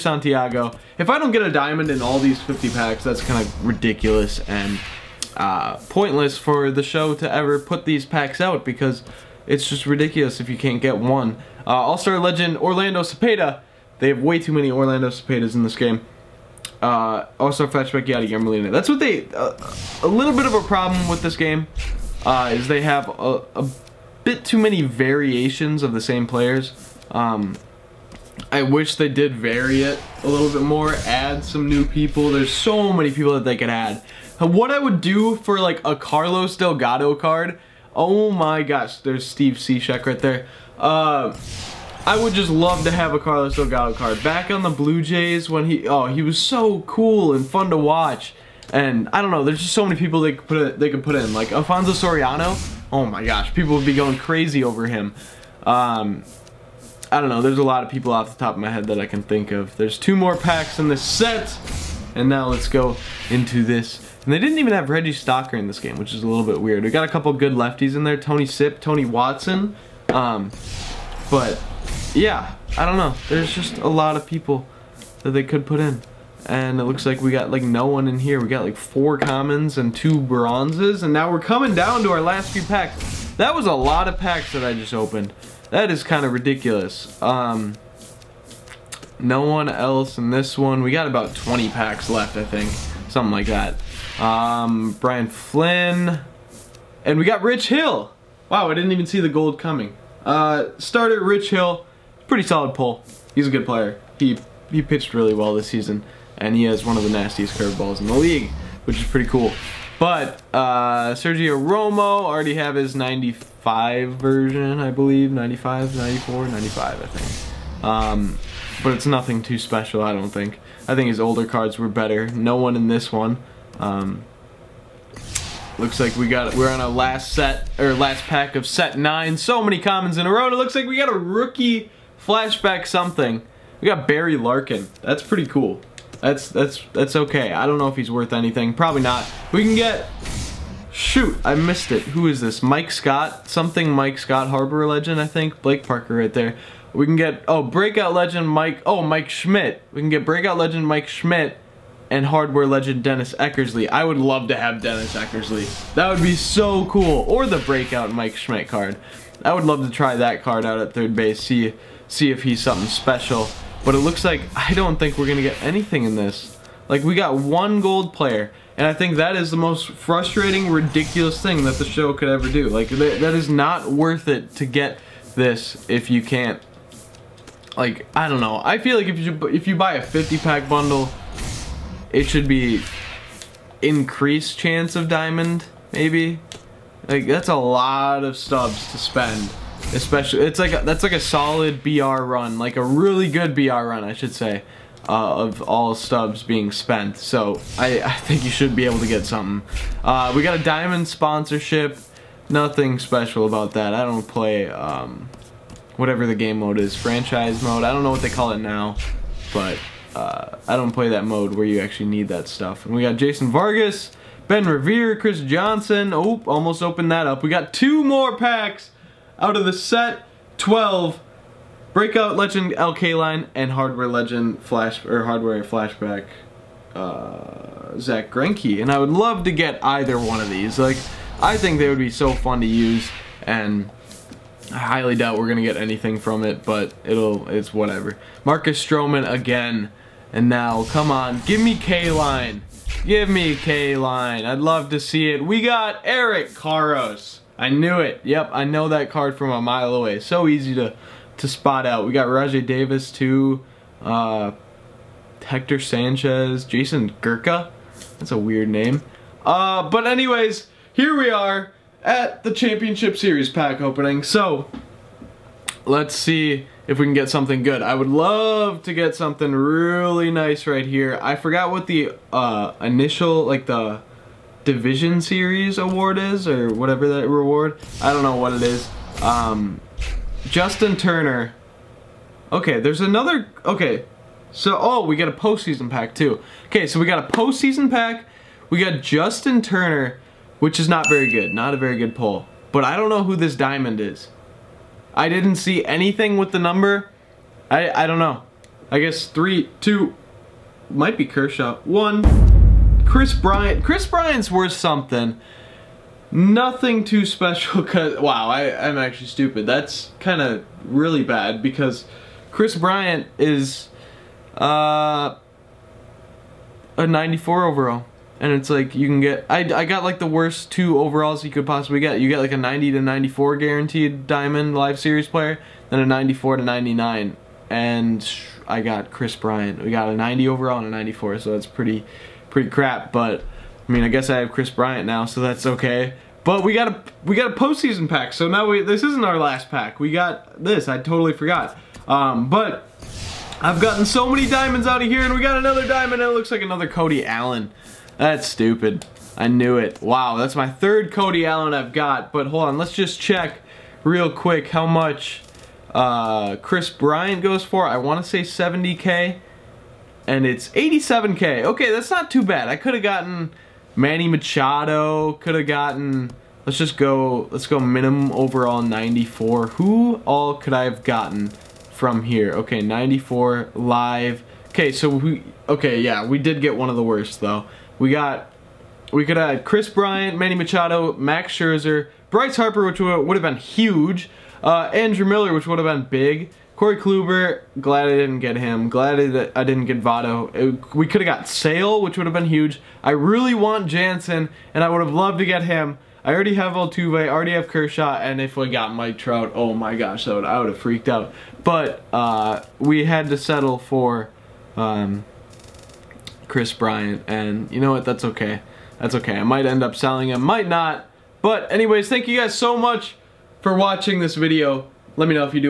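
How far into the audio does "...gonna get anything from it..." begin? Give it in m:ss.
3:55.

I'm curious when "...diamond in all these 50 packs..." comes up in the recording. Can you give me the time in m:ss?
0:01.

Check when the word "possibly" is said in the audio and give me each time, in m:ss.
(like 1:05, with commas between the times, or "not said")
5:21.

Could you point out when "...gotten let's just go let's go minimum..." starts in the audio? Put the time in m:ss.
6:05.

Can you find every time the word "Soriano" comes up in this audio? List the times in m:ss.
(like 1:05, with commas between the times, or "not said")
0:51.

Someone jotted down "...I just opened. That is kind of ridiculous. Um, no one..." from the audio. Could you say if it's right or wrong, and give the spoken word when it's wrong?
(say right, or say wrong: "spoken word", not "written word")
right.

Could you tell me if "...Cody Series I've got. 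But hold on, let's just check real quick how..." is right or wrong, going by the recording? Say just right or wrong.
wrong.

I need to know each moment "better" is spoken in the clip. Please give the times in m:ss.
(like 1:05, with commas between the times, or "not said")
2:01.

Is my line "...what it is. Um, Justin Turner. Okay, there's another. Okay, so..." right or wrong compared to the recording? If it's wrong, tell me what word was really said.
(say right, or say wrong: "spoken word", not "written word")
right.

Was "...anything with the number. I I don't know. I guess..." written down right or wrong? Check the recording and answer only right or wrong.
right.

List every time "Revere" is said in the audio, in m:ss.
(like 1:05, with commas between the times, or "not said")
3:34.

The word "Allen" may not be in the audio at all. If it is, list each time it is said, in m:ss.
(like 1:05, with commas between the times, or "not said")
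5:47, 5:51.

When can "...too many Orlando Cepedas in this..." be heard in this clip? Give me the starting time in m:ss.
0:14.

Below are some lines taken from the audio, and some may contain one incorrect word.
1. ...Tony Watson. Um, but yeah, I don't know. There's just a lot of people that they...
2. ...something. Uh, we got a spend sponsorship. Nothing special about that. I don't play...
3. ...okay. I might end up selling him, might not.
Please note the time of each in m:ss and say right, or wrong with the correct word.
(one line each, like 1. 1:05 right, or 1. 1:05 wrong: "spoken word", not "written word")
1. 1:08 right
2. 3:19 wrong: "diamond", not "spend"
3. 6:49 right.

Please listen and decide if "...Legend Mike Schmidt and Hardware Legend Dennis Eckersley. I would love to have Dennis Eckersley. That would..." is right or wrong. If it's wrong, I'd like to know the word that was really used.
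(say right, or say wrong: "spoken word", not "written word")
right.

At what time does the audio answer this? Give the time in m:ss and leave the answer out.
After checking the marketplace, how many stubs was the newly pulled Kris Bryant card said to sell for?
6:00.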